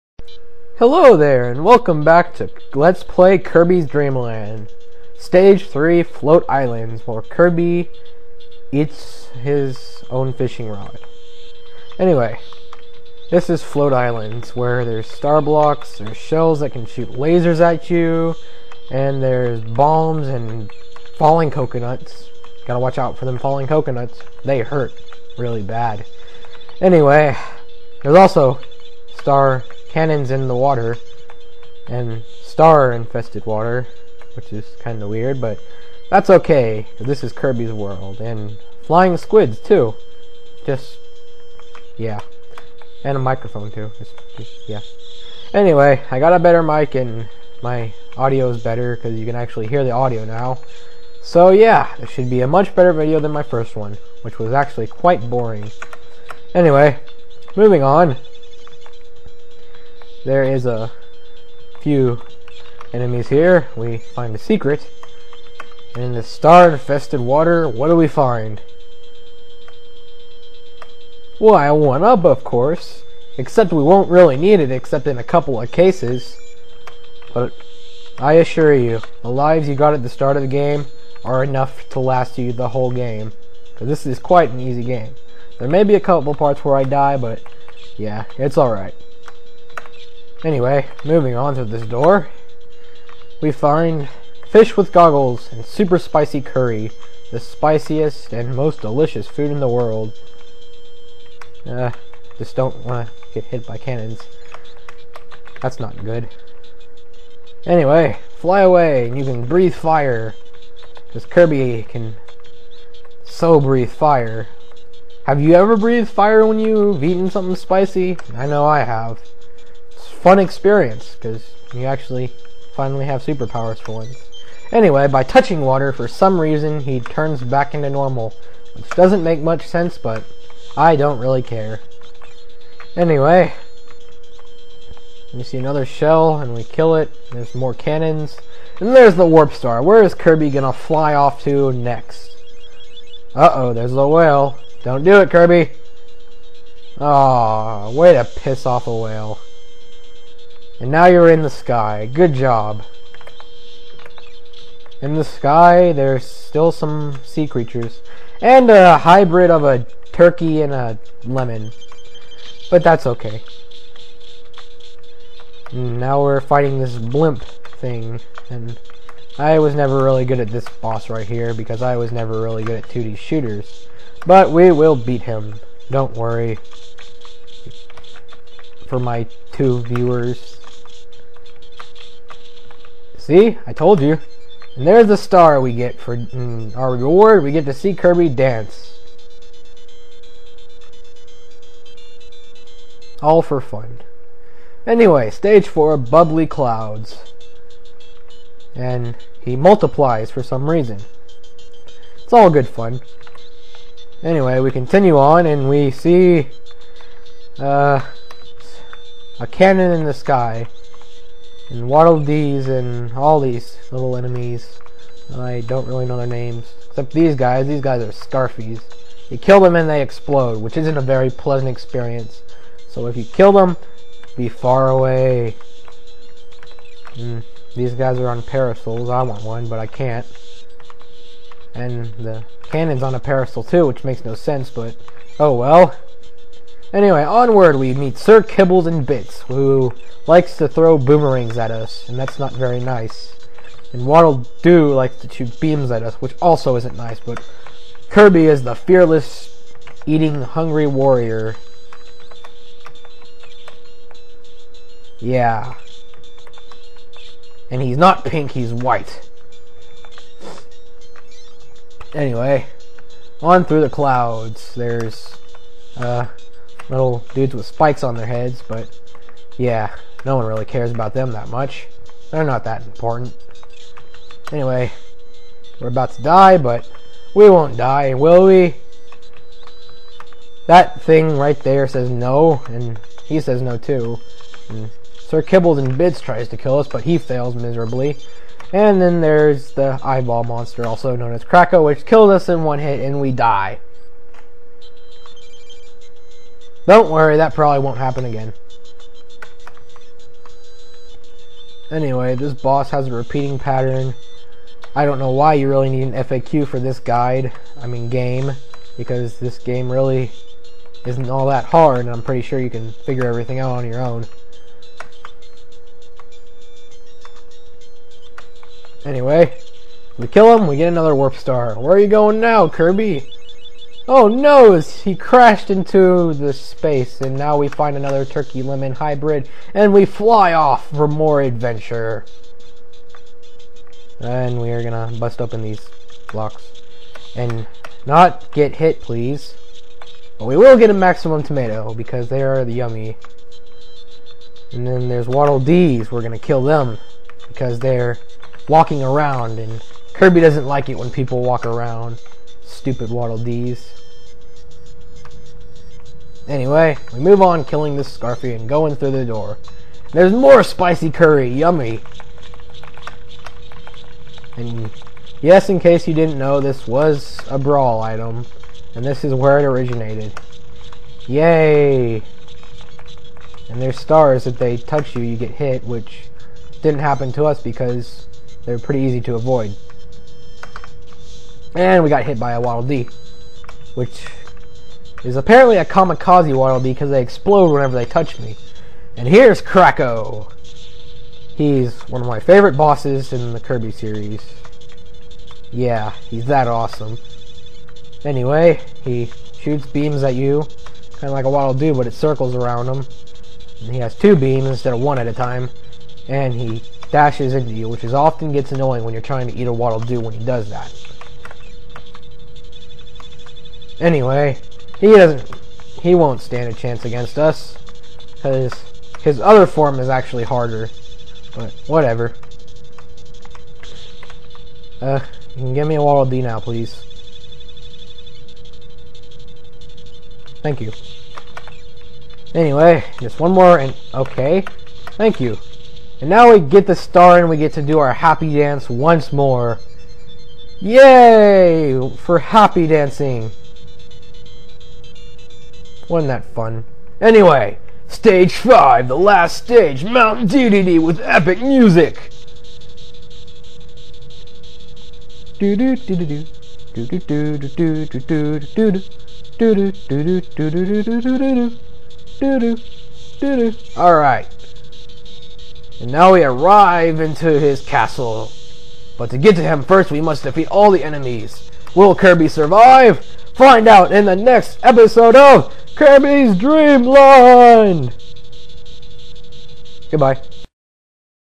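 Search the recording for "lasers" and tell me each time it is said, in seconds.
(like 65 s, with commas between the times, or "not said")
17 s.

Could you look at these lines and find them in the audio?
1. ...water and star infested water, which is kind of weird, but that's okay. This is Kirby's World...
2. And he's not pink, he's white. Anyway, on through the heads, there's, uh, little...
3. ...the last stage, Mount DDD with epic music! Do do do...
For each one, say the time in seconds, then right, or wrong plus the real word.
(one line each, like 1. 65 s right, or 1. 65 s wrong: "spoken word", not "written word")
1. 30 s right
2. 257 s wrong: "clouds", not "heads"
3. 449 s right.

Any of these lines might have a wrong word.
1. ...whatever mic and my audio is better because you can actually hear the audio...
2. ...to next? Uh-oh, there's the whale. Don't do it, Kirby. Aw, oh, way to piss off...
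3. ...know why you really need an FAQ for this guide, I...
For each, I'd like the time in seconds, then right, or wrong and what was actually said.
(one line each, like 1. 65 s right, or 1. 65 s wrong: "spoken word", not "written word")
1. 46 s wrong: "better", not "whatever"
2. 141 s right
3. 305 s right.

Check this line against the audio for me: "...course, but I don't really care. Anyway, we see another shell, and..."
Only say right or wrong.
wrong.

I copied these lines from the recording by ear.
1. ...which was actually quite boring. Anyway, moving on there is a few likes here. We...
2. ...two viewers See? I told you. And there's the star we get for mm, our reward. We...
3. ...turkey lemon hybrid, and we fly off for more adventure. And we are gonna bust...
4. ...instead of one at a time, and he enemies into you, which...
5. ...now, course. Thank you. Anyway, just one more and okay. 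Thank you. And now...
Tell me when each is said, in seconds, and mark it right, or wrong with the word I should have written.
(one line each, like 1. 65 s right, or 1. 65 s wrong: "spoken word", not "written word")
1. 54 s wrong: "enemies", not "likes"
2. 179 s right
3. 328 s right
4. 404 s wrong: "dashes", not "enemies"
5. 426 s wrong: "please", not "course".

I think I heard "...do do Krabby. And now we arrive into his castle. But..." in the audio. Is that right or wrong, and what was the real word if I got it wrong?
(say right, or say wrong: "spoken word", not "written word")
wrong: "Alright", not "Krabby".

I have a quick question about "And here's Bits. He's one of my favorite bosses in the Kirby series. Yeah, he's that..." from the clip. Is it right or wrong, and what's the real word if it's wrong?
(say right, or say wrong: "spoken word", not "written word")
wrong: "Kracko", not "Bits".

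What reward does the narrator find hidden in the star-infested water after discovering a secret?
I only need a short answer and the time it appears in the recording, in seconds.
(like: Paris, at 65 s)
1-up, at 71 s.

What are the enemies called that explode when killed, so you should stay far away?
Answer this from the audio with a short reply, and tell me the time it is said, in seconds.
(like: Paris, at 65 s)
Scarfies, at 218 s.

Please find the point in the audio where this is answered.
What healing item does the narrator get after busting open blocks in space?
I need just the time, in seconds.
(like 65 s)
340 s.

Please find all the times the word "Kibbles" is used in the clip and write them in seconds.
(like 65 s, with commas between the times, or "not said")
238 s, 285 s.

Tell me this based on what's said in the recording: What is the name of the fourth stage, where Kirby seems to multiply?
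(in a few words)
Bubbly Clouds.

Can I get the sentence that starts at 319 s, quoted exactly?
Anyway, we kill him, we get another warp star.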